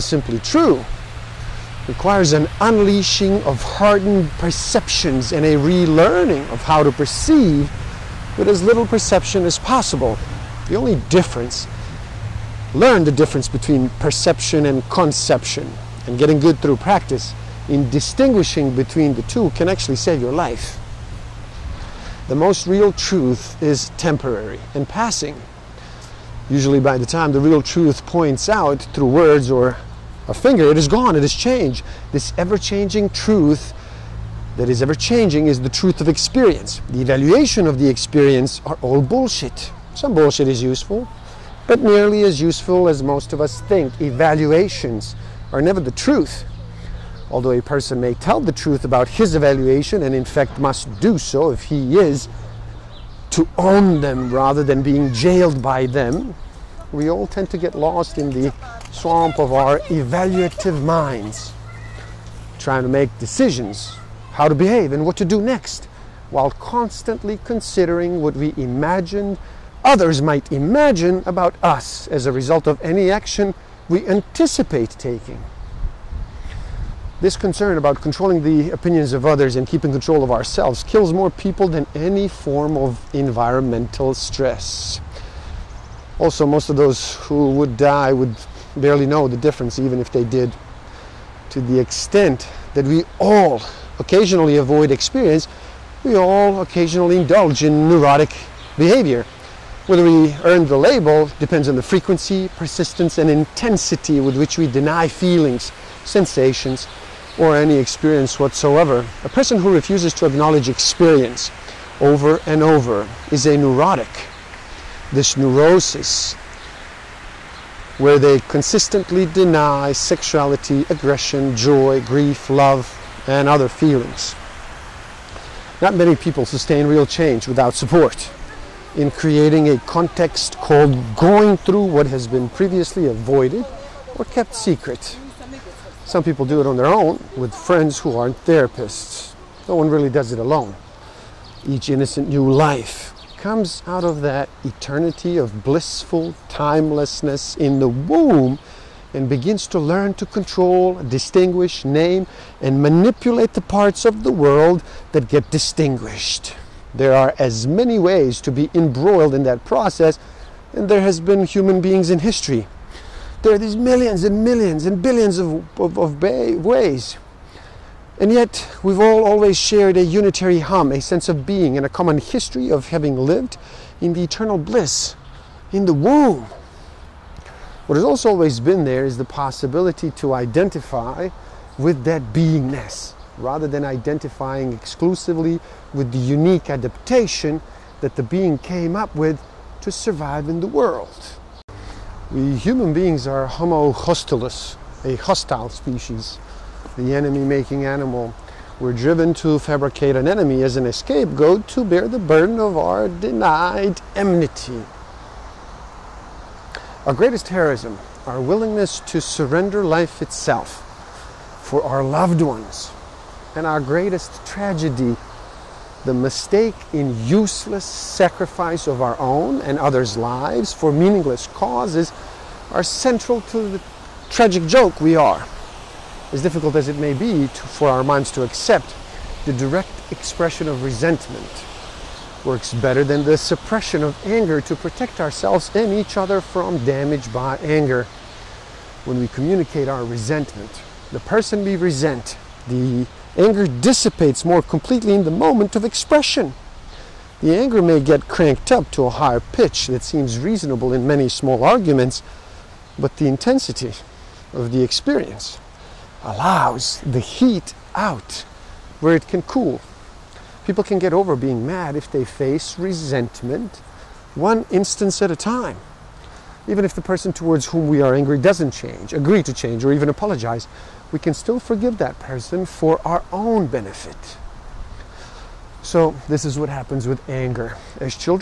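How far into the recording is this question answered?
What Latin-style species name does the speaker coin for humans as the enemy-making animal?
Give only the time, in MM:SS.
03:13.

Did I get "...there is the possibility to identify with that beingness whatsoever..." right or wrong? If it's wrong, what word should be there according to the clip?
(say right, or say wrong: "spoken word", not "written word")
wrong: "rather", not "whatsoever".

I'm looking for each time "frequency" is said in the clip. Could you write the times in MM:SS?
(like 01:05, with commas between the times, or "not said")
01:41.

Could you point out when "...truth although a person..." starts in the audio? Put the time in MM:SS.
00:45.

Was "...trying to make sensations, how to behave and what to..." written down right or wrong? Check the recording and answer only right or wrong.
wrong.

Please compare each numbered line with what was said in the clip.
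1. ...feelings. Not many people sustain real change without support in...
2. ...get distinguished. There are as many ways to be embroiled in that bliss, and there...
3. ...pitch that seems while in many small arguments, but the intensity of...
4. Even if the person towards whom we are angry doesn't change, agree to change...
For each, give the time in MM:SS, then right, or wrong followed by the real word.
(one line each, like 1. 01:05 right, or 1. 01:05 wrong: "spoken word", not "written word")
1. 02:03 right
2. 02:35 wrong: "process", not "bliss"
3. 04:09 wrong: "reasonable", not "while"
4. 04:26 right.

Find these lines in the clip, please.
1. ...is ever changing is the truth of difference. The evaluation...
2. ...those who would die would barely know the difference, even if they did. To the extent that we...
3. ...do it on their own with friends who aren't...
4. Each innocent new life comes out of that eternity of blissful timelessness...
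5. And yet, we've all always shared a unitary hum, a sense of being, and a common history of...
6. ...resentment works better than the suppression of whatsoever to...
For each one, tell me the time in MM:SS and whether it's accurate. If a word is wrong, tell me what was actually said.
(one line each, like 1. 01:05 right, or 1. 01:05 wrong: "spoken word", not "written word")
1. 00:34 wrong: "experience", not "difference"
2. 01:26 right
3. 02:16 right
4. 02:21 right
5. 02:48 right
6. 03:50 wrong: "anger", not "whatsoever".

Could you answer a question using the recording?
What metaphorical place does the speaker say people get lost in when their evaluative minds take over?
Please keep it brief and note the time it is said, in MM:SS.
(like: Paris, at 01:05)
the swamp, at 00:58.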